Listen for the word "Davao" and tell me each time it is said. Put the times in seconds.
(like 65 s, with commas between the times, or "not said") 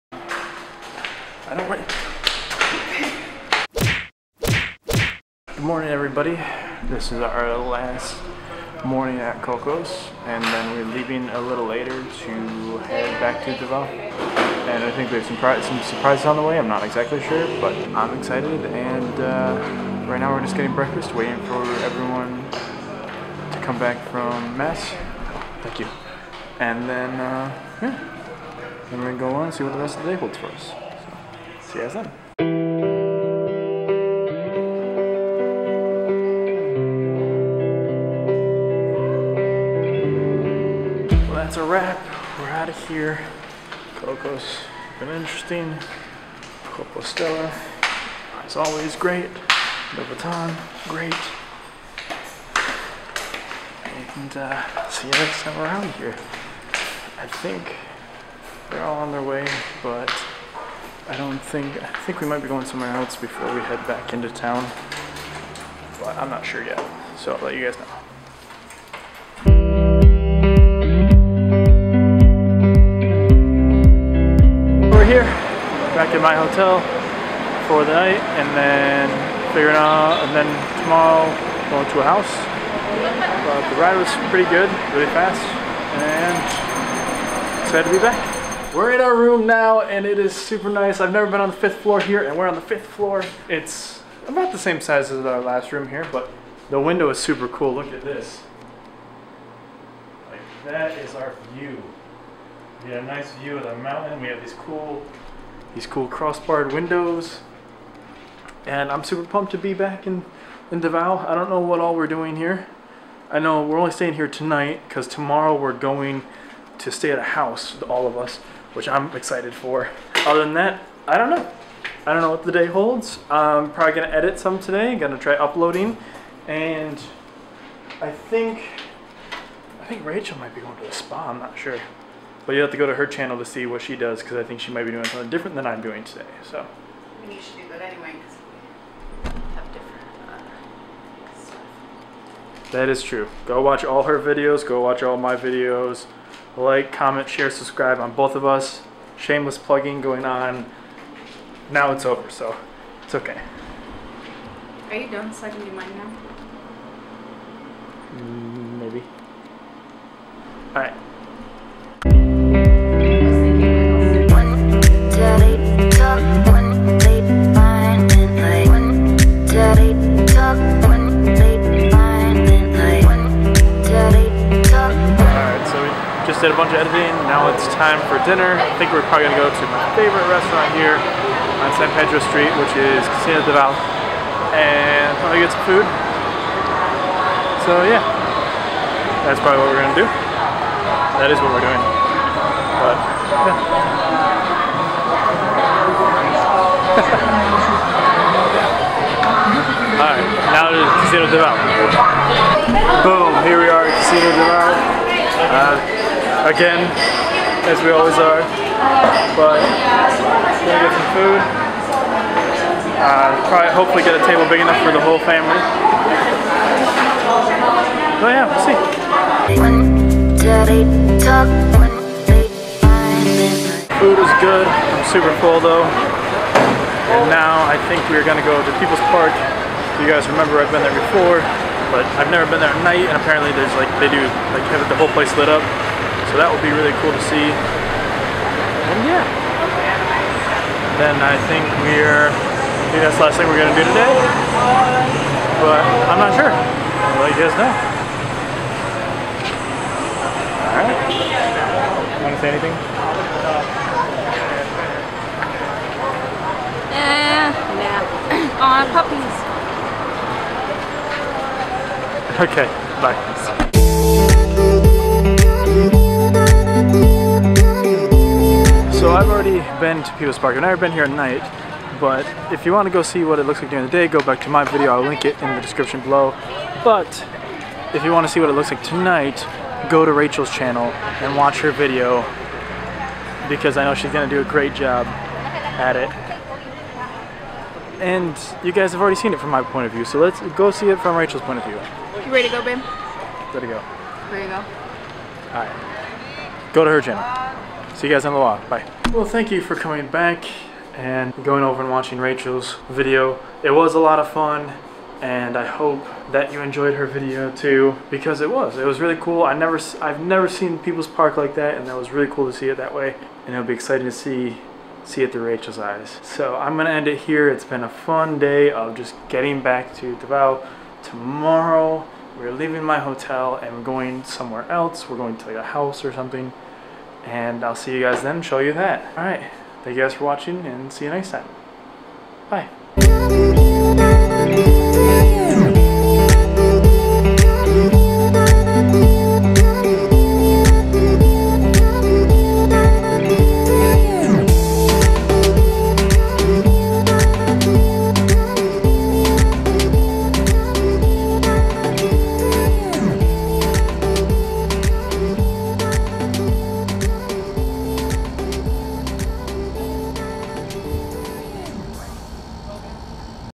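13 s, 110 s, 320 s.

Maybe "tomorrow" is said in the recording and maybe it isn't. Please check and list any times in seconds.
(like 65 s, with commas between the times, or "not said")
80 s, 115 s, 321 s.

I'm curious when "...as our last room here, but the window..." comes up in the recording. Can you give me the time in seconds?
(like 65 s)
95 s.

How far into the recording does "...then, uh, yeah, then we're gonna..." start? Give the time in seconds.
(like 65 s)
26 s.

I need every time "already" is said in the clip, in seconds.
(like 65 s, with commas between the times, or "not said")
269 s, 289 s.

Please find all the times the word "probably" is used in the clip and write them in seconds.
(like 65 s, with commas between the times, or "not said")
123 s, 179 s, 185 s, 189 s, 213 s.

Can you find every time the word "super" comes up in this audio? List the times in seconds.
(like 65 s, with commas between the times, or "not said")
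90 s, 97 s, 109 s, 225 s.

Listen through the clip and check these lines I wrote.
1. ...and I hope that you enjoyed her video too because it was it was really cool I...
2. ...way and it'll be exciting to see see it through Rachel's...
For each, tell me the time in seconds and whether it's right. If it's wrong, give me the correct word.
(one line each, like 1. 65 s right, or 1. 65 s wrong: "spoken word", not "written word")
1. 305 s right
2. 312 s right.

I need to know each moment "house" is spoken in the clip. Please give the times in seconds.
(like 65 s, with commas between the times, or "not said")
82 s, 117 s, 325 s.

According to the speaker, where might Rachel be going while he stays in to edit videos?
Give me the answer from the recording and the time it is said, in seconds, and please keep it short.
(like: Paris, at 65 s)
The spa, at 130 s.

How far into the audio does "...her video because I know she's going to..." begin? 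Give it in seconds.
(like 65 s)
281 s.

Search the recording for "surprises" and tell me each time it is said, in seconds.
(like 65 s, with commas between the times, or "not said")
15 s.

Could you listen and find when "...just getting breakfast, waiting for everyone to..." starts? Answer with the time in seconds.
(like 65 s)
20 s.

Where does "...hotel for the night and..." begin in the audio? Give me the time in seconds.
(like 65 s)
76 s.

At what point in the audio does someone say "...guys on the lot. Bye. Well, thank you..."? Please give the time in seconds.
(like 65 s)
298 s.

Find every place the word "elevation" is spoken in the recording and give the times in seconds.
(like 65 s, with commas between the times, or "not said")
not said.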